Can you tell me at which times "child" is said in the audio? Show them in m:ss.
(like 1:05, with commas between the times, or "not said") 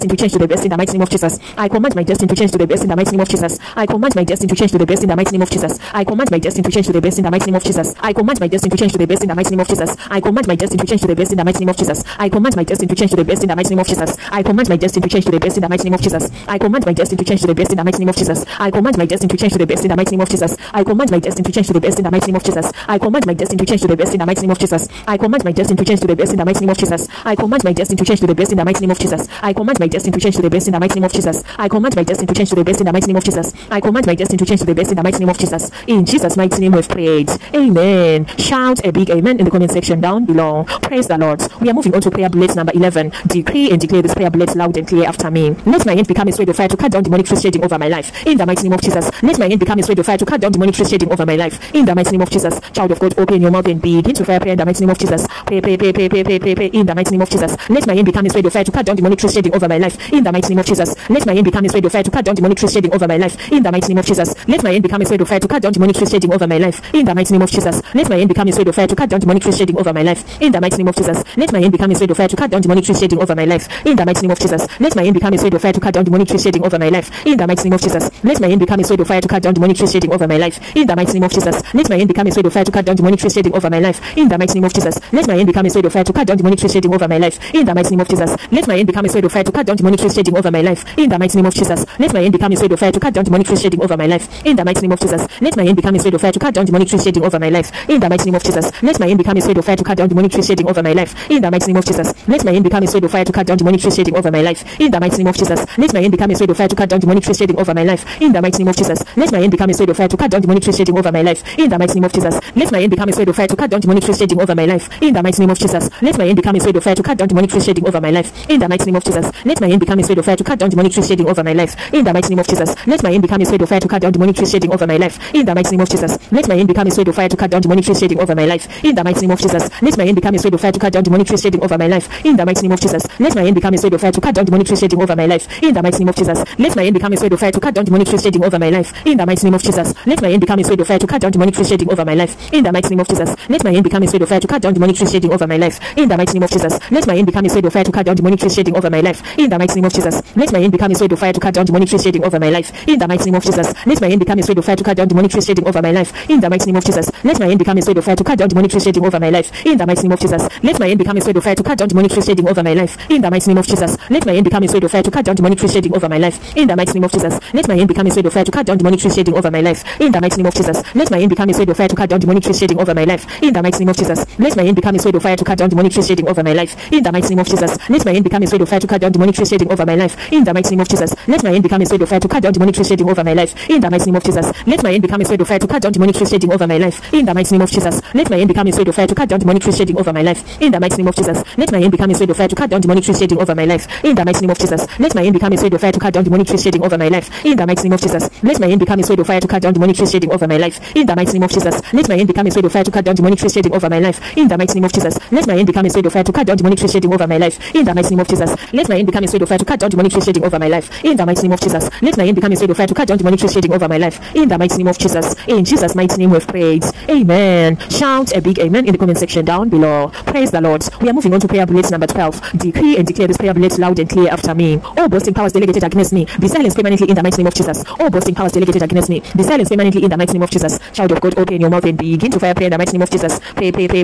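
0:52, 3:50.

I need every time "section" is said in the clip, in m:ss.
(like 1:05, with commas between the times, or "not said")
0:39, 3:39.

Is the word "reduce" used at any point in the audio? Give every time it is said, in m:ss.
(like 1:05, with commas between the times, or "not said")
not said.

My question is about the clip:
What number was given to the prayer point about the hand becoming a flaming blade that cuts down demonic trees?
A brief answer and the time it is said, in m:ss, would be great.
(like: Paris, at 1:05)
11, at 0:42.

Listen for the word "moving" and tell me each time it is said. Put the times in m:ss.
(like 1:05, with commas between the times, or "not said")
0:41, 3:41.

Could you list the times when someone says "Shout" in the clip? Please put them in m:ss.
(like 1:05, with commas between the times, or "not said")
0:38, 3:37.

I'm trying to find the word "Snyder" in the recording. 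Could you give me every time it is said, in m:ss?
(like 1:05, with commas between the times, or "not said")
not said.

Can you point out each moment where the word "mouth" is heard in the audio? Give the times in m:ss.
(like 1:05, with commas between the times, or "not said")
0:53, 3:51.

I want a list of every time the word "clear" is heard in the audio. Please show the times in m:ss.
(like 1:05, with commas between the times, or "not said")
0:44, 3:44.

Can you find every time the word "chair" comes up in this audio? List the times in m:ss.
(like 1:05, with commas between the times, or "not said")
not said.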